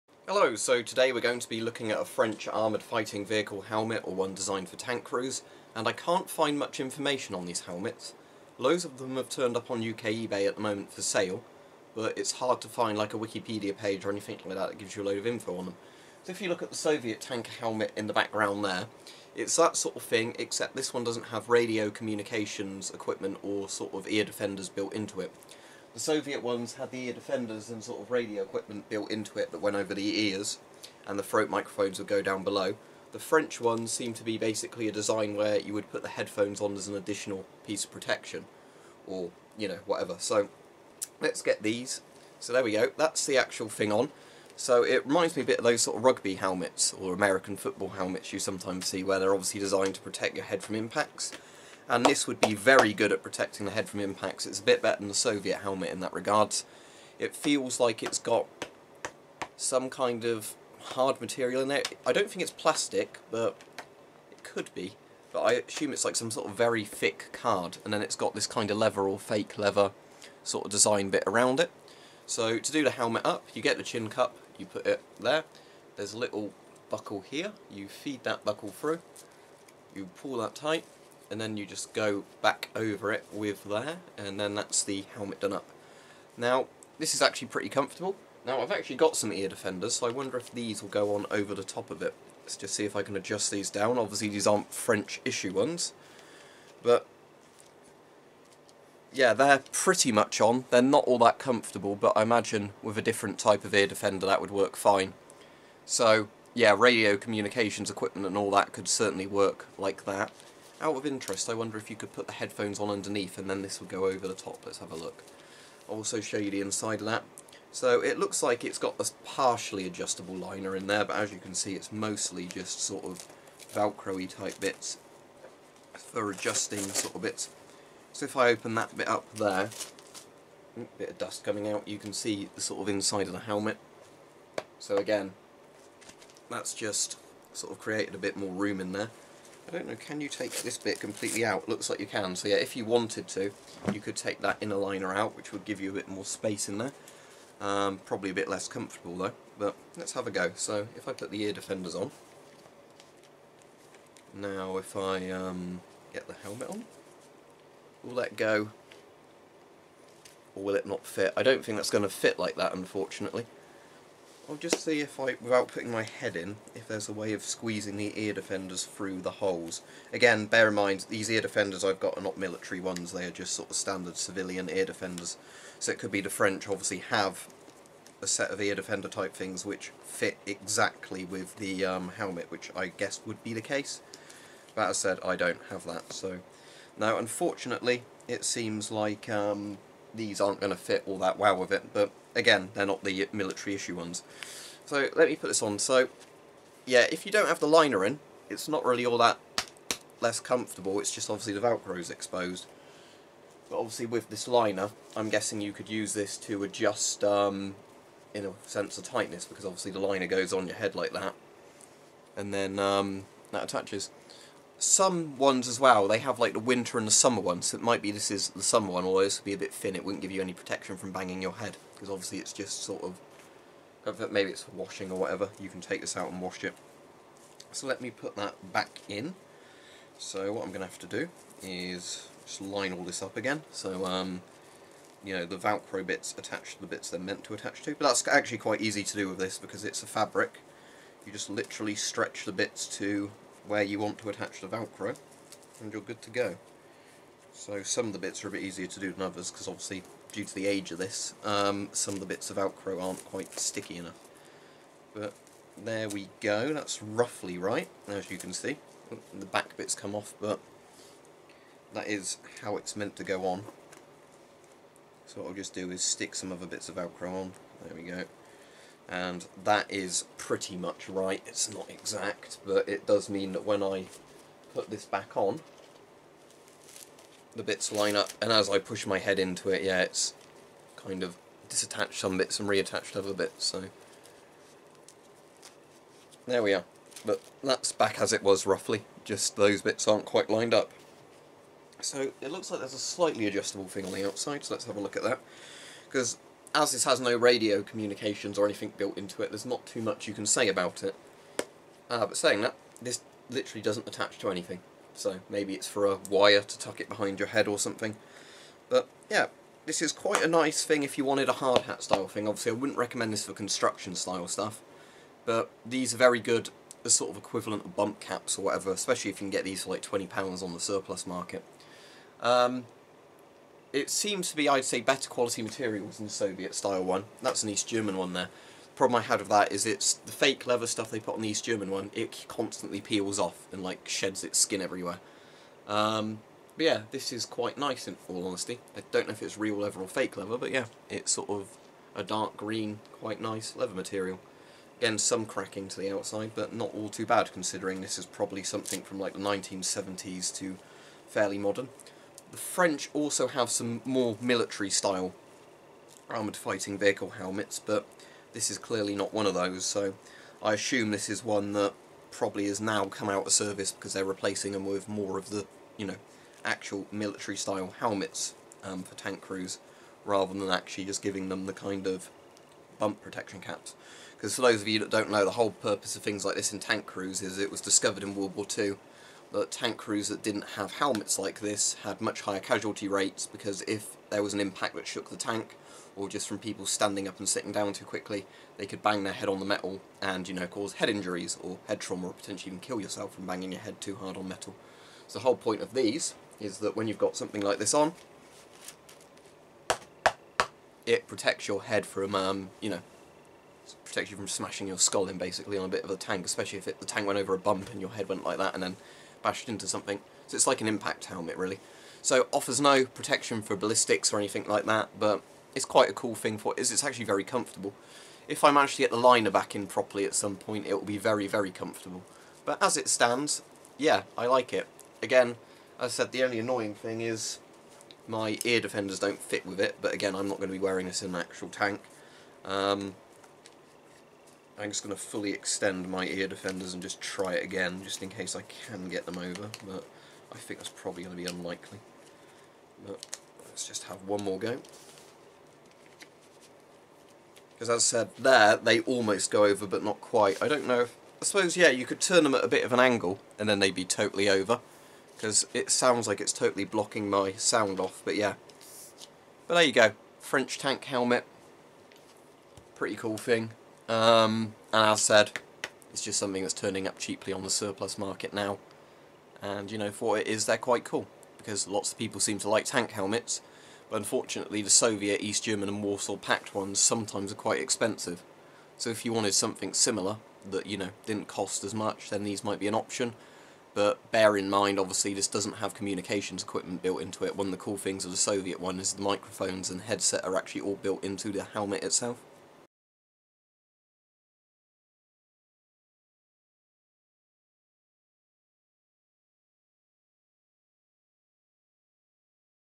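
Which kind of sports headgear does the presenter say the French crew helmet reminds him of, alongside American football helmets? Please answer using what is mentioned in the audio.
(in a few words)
rugby helmets.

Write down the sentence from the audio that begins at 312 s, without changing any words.
Obviously I wouldn't recommend this for construction style stuff.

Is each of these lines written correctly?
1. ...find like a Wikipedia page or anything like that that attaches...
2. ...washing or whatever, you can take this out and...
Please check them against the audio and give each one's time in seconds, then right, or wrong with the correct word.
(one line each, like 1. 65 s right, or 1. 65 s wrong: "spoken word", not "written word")
1. 12 s wrong: "gives", not "attaches"
2. 224 s right.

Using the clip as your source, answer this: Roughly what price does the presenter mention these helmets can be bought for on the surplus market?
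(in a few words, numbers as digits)
£20.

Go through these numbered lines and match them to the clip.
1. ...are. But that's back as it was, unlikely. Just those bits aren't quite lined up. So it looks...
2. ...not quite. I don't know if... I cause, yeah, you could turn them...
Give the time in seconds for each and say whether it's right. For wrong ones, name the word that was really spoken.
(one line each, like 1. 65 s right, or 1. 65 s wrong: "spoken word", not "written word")
1. 286 s wrong: "roughly", not "unlikely"
2. 450 s wrong: "suppose", not "cause".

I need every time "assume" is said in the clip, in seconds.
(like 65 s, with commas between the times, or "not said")
65 s, 360 s.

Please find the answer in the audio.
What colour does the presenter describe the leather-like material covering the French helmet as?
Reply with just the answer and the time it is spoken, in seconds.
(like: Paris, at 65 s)
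dark green, at 342 s.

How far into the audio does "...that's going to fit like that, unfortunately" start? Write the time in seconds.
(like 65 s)
161 s.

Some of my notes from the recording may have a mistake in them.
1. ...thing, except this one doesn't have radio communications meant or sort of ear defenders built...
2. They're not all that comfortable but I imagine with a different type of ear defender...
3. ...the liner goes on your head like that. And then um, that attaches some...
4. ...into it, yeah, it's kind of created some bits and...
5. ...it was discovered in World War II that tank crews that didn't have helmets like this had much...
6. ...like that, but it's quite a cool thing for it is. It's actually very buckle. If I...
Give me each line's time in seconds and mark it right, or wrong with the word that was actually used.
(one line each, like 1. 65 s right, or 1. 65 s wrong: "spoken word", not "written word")
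1. 20 s wrong: "equipment", not "meant"
2. 100 s right
3. 209 s right
4. 279 s wrong: "disattached", not "created"
5. 377 s right
6. 414 s wrong: "comfortable", not "buckle".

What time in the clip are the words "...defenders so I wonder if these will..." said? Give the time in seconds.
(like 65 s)
89 s.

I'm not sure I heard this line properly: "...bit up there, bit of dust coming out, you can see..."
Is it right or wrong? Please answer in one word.
right.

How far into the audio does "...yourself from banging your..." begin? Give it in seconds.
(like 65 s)
392 s.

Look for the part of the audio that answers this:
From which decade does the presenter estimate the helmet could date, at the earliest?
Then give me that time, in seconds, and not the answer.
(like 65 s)
349 s.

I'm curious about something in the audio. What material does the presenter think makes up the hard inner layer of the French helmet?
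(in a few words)
very thick card.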